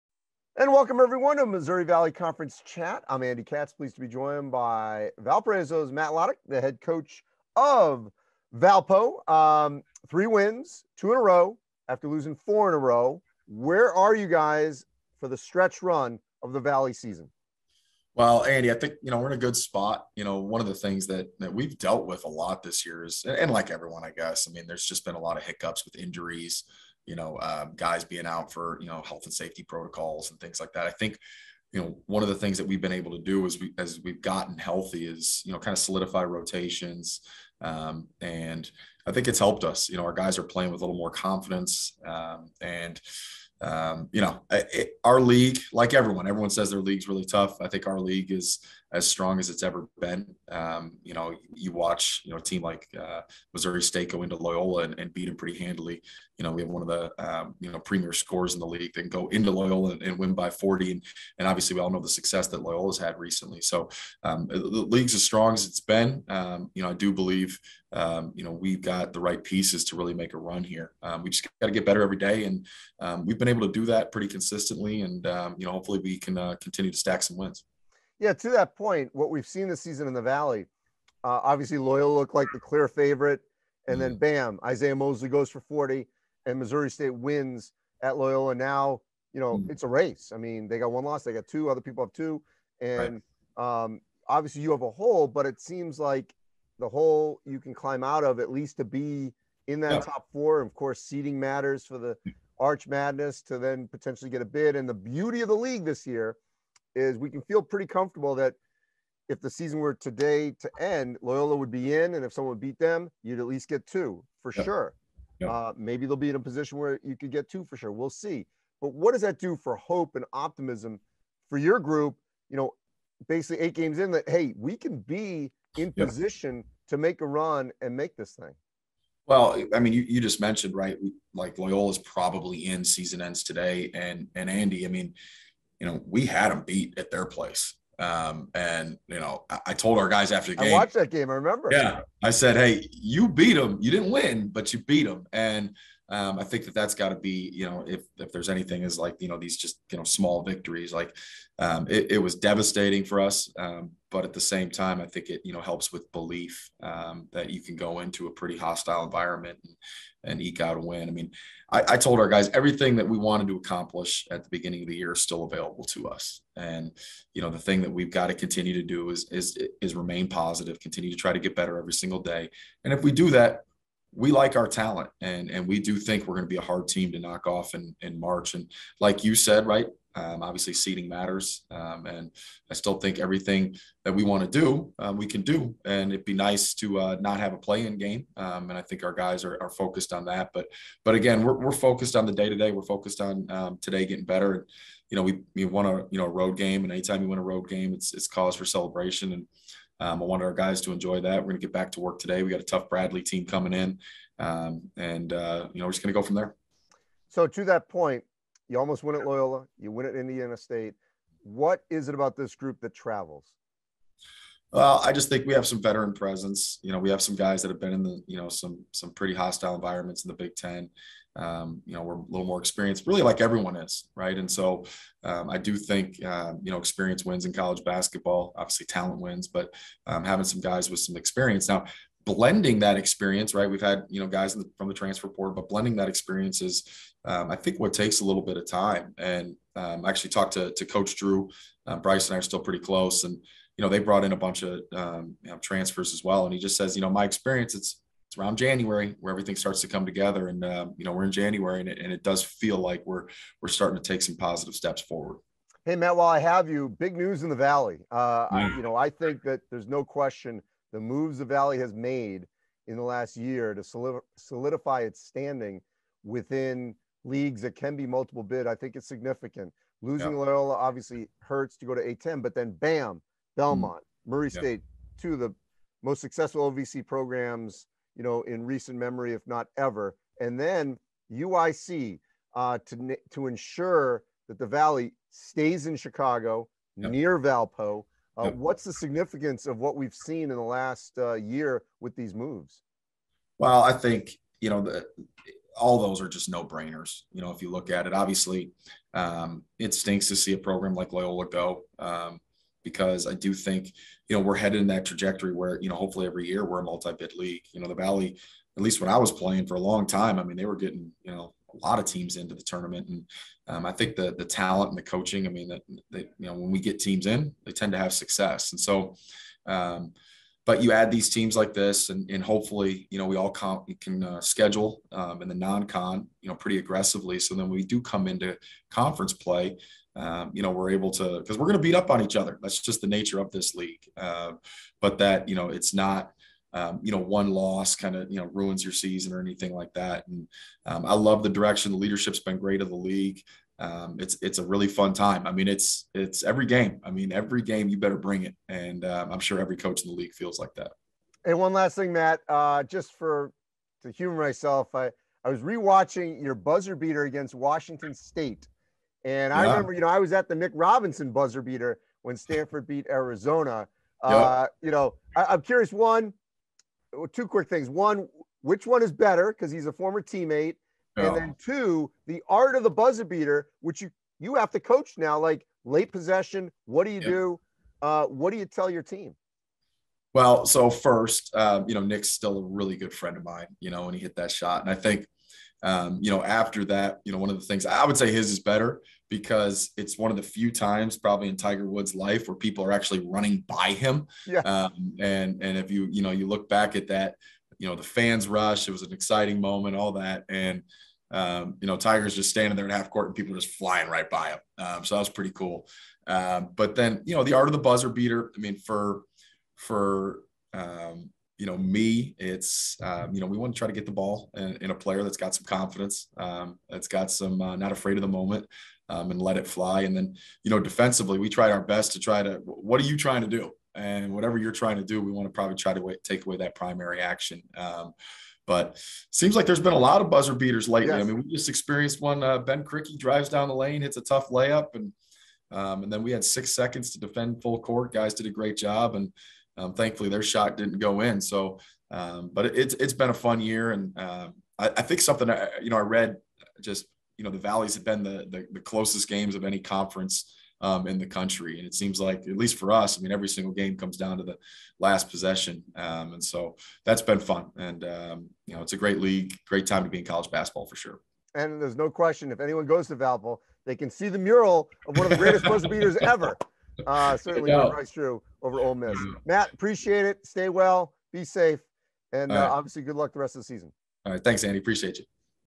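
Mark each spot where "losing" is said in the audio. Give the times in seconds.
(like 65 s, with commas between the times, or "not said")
12 s, 270 s.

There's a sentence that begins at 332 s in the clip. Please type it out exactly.
That's just the nature of this league.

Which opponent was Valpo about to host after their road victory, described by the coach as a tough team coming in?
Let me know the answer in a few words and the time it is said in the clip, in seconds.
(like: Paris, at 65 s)
Bradley, at 202 s.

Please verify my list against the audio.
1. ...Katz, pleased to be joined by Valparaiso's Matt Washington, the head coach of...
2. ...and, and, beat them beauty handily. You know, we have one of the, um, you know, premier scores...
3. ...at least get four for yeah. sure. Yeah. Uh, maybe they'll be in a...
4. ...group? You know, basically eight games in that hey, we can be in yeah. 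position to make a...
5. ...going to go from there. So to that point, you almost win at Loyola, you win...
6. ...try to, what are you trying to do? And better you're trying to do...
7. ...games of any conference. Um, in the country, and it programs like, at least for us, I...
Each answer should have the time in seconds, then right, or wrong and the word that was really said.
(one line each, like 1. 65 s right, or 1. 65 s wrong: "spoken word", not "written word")
1. 3 s wrong: "Lottich", not "Washington"
2. 54 s wrong: "pretty", not "beauty"
3. 113 s wrong: "two", not "four"
4. 121 s right
5. 206 s right
6. 422 s wrong: "whatever", not "better"
7. 449 s wrong: "seems", not "programs".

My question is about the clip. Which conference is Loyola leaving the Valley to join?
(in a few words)
A10.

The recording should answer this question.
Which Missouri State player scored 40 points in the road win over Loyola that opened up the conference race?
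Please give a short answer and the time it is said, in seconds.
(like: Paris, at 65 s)
Isaiah Mosley, at 84 s.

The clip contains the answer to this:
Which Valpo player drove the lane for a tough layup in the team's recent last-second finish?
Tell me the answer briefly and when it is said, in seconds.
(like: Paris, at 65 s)
Ben Krikke, at 432 s.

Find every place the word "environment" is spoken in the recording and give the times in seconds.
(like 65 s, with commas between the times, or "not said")
159 s, 219 s.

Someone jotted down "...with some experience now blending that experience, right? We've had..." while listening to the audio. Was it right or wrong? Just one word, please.
right.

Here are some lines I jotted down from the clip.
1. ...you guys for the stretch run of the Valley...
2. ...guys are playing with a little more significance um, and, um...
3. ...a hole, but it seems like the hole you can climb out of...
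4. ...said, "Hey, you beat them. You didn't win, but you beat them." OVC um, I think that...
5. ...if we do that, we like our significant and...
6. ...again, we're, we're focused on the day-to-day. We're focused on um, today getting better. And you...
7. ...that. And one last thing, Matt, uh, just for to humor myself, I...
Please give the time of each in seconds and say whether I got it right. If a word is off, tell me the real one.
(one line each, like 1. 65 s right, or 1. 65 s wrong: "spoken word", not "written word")
1. 14 s right
2. 40 s wrong: "confidence", not "significance"
3. 94 s right
4. 142 s wrong: "And", not "OVC"
5. 172 s wrong: "talent", not "significant"
6. 191 s right
7. 350 s right.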